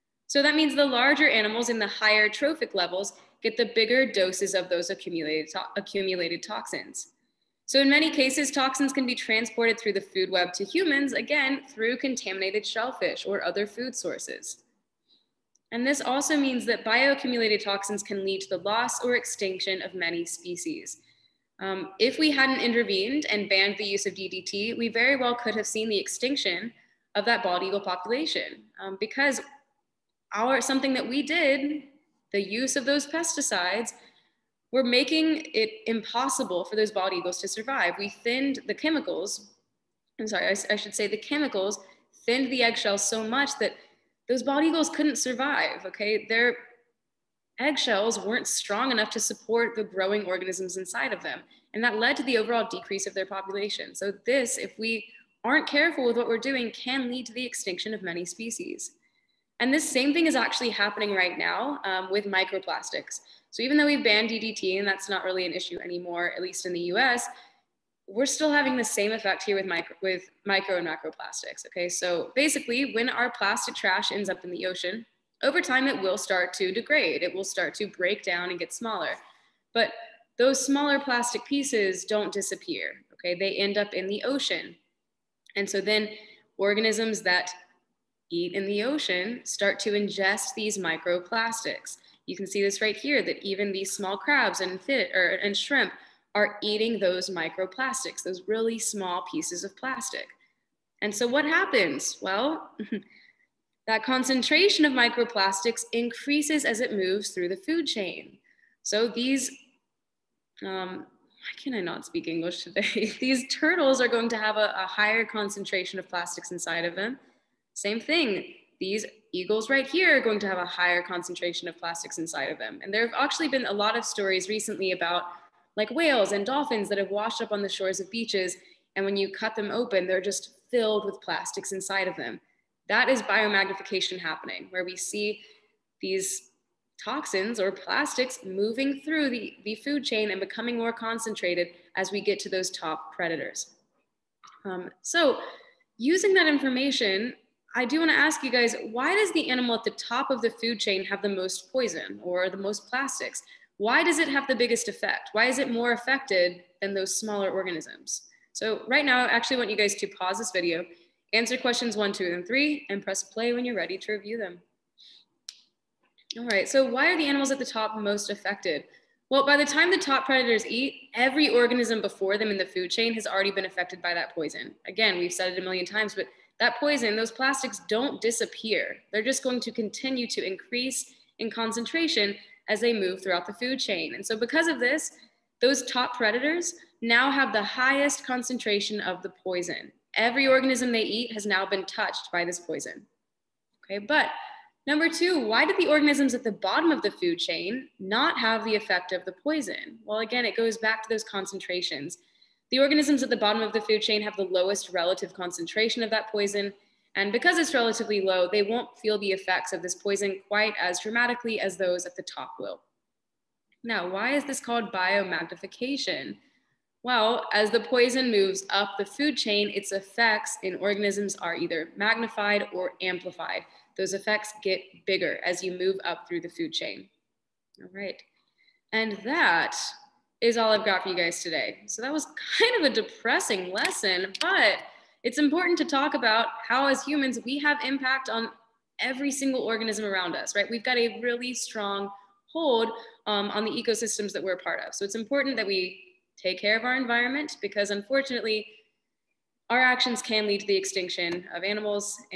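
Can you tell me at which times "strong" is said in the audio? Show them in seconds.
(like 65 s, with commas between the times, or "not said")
48 s, 241 s.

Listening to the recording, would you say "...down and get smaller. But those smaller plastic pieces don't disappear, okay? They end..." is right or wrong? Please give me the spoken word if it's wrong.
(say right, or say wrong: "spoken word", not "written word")
right.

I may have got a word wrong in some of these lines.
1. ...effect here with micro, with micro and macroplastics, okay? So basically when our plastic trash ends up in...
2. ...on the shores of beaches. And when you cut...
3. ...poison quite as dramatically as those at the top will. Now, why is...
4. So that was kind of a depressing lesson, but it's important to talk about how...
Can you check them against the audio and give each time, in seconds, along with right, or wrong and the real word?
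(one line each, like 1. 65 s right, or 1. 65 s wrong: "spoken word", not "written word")
1. 69 s right
2. 127 s right
3. 209 s right
4. 231 s right.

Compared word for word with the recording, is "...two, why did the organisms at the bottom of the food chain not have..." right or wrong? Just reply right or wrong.
right.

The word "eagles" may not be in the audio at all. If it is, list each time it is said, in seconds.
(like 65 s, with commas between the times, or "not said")
27 s, 37 s, 44 s, 119 s.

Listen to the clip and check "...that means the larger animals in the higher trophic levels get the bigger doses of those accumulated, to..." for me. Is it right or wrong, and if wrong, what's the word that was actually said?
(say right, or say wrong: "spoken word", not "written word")
right.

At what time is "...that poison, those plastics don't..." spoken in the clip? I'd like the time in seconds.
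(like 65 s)
176 s.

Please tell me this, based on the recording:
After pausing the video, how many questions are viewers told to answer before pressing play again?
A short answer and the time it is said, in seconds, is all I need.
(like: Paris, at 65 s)
3, at 161 s.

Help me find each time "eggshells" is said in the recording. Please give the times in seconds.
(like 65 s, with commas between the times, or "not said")
42 s, 47 s.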